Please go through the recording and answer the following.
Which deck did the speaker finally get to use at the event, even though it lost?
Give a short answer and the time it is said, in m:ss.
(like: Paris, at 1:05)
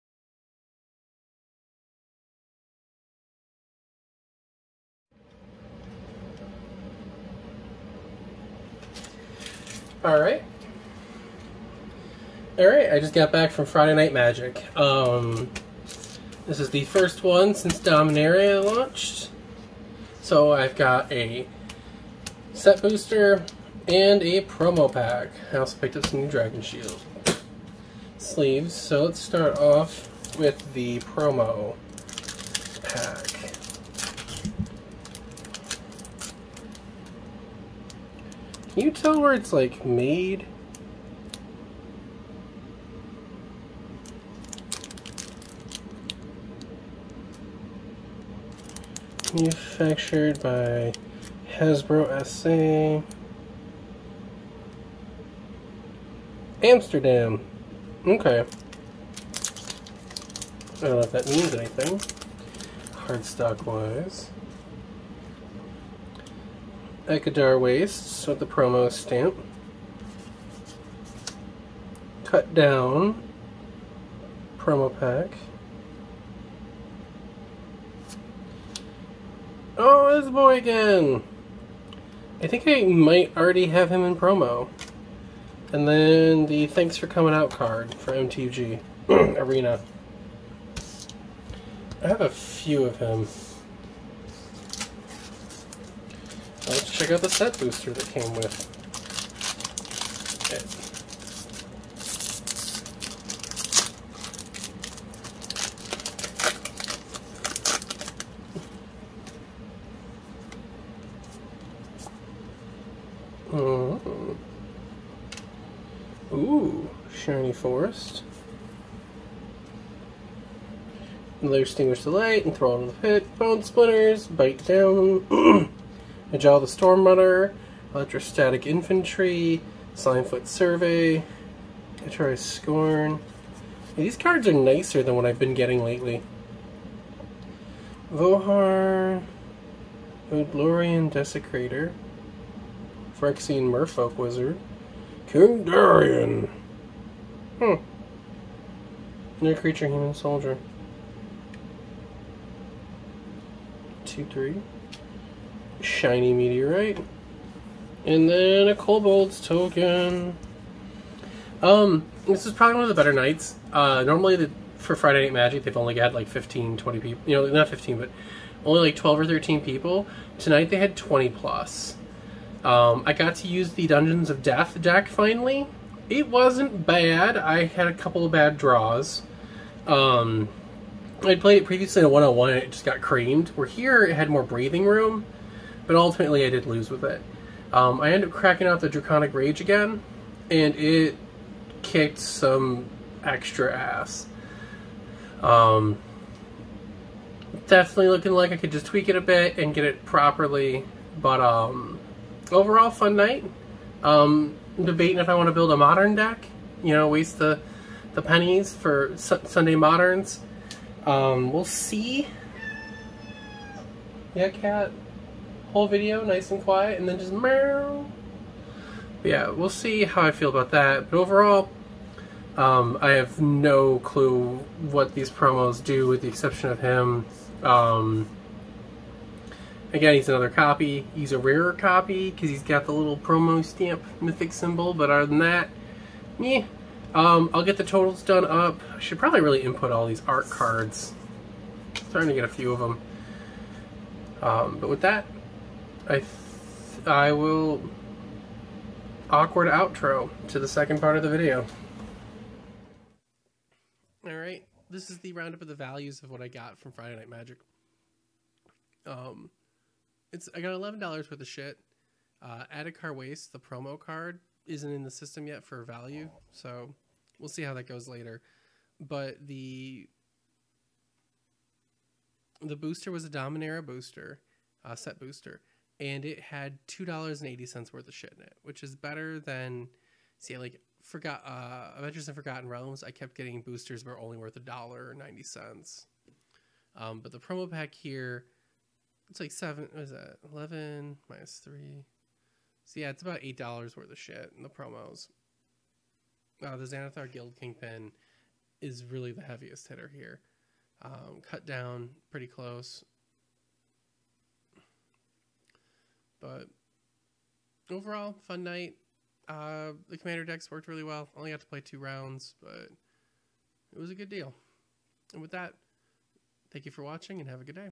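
Dungeons of Death, at 2:53.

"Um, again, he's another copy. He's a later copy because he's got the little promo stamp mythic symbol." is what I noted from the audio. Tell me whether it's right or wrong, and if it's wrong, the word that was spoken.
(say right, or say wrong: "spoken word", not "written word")
wrong: "rarer", not "later".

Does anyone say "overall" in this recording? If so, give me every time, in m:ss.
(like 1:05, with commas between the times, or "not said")
3:22, 3:41, 5:07.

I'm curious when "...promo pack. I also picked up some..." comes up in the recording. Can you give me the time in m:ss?
0:24.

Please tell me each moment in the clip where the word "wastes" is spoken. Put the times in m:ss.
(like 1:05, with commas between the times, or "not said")
1:07, 3:27, 4:23.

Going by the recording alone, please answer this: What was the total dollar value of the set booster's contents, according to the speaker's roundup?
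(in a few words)
$2.80.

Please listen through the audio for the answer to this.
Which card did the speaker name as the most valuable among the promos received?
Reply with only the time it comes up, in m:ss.
4:56.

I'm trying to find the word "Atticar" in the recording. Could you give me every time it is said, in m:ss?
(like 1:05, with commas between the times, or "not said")
4:22.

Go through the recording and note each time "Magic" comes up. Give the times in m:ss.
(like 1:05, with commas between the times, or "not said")
0:14, 2:45, 4:17.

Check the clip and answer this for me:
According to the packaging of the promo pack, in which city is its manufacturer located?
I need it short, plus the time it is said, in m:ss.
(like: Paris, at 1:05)
Amsterdam, at 0:56.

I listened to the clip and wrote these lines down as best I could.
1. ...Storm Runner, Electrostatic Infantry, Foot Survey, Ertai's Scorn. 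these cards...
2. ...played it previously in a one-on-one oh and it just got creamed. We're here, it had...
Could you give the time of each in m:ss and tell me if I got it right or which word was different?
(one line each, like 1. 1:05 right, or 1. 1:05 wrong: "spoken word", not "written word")
1. 2:06 right
2. 3:01 right.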